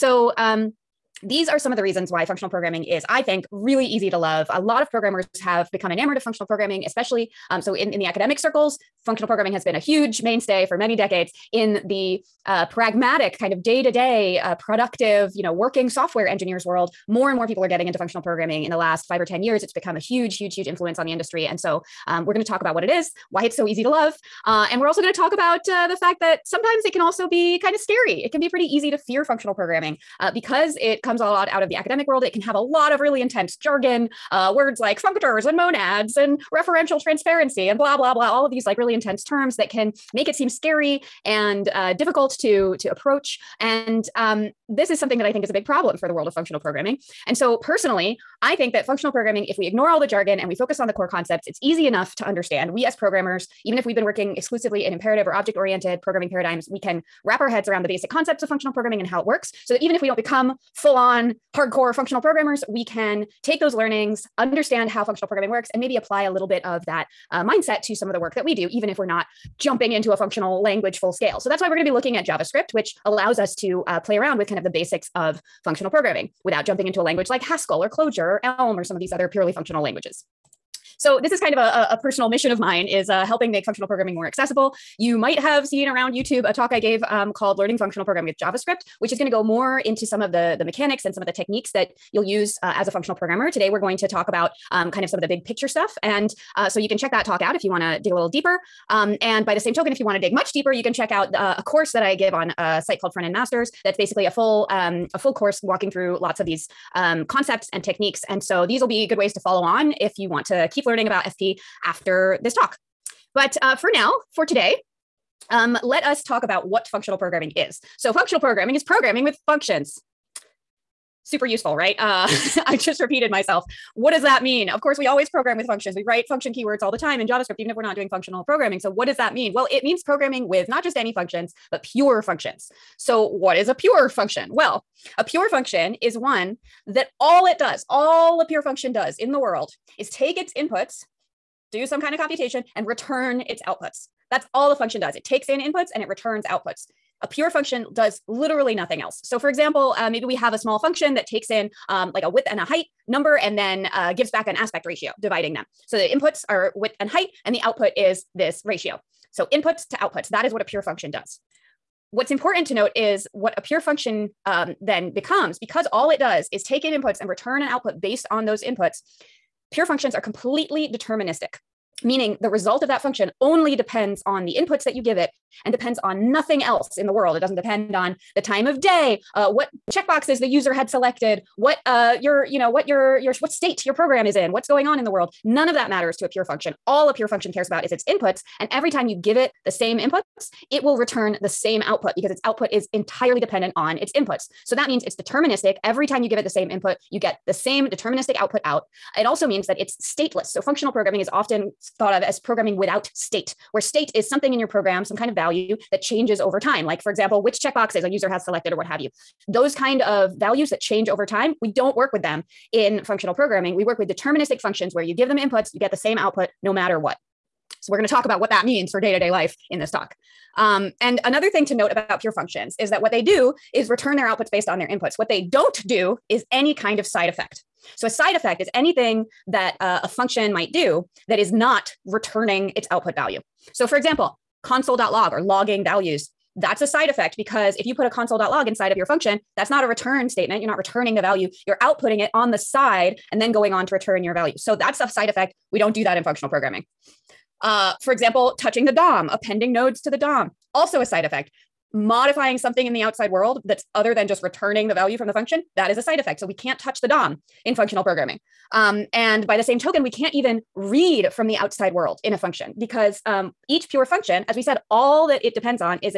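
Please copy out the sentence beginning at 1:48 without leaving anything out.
And so these will be good ways to follow on if you want to keep learning about FP after this talk.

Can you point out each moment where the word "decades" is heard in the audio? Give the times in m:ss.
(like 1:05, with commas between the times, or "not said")
0:10.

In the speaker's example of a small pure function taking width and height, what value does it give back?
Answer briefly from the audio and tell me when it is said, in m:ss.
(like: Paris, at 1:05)
aspect ratio, at 2:34.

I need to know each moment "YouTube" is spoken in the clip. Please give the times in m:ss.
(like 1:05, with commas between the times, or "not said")
1:26.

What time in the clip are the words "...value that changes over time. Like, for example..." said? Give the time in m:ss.
3:25.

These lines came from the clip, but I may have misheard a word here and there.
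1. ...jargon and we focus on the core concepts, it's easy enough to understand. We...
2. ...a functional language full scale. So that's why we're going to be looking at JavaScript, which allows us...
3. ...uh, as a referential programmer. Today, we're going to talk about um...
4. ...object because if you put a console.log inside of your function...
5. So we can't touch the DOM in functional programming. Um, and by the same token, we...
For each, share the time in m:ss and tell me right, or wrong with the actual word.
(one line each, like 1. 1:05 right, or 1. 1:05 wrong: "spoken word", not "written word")
1. 0:50 right
2. 1:10 right
3. 1:32 wrong: "functional", not "referential"
4. 3:57 wrong: "effect", not "object"
5. 4:16 right.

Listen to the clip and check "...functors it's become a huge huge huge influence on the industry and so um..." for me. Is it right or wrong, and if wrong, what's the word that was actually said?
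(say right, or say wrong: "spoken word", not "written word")
wrong: "years", not "functors".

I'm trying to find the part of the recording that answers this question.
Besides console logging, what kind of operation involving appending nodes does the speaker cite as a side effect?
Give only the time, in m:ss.
4:08.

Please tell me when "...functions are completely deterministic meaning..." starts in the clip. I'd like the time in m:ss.
2:49.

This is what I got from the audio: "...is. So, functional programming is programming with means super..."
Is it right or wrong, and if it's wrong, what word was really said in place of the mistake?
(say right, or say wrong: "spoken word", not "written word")
wrong: "functions", not "means".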